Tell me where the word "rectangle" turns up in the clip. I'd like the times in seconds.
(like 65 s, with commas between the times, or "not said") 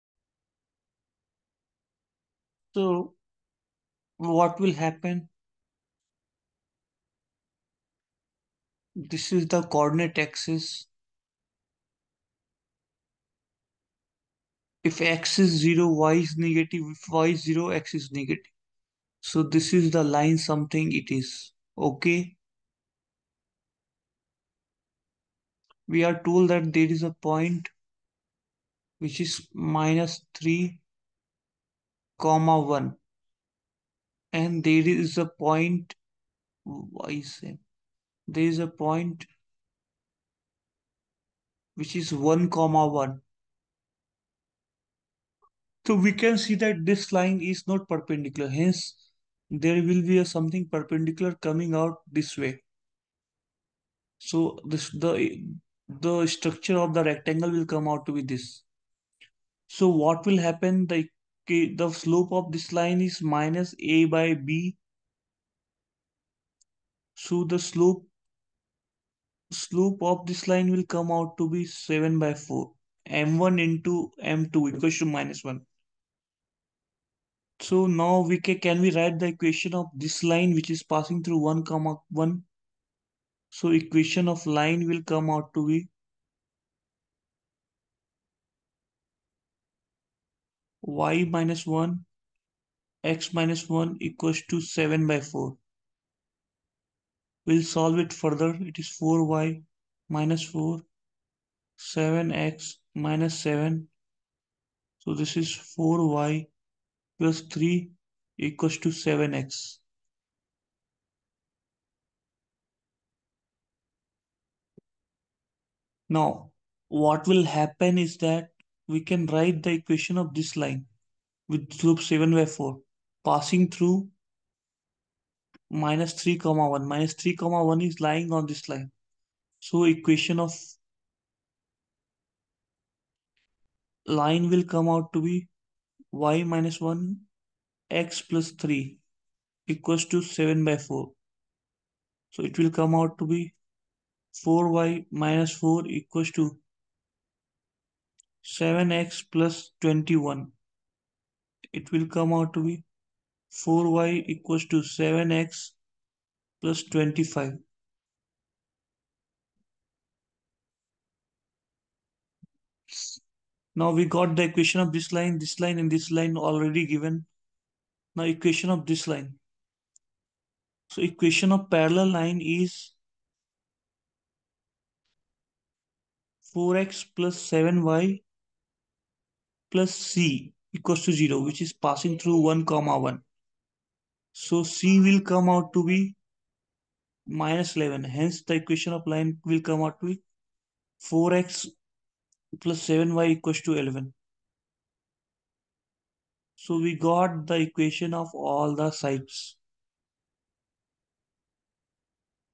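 57 s.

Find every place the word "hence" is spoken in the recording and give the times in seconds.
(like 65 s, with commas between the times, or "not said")
48 s, 188 s.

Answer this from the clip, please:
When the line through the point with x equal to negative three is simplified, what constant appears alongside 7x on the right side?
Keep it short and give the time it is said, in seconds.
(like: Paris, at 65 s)
25, at 156 s.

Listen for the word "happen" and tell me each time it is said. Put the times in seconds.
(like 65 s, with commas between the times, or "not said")
4 s, 60 s, 117 s.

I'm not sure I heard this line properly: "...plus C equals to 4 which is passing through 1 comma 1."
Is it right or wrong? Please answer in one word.
wrong.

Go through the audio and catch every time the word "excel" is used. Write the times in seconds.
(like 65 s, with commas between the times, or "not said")
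not said.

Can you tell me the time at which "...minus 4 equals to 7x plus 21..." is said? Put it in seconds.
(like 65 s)
145 s.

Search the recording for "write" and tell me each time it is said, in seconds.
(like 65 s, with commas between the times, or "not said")
78 s, 119 s.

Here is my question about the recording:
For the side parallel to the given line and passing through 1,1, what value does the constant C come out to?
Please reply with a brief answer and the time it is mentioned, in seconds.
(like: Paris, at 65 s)
-11, at 187 s.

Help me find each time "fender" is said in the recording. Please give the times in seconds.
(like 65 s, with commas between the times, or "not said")
not said.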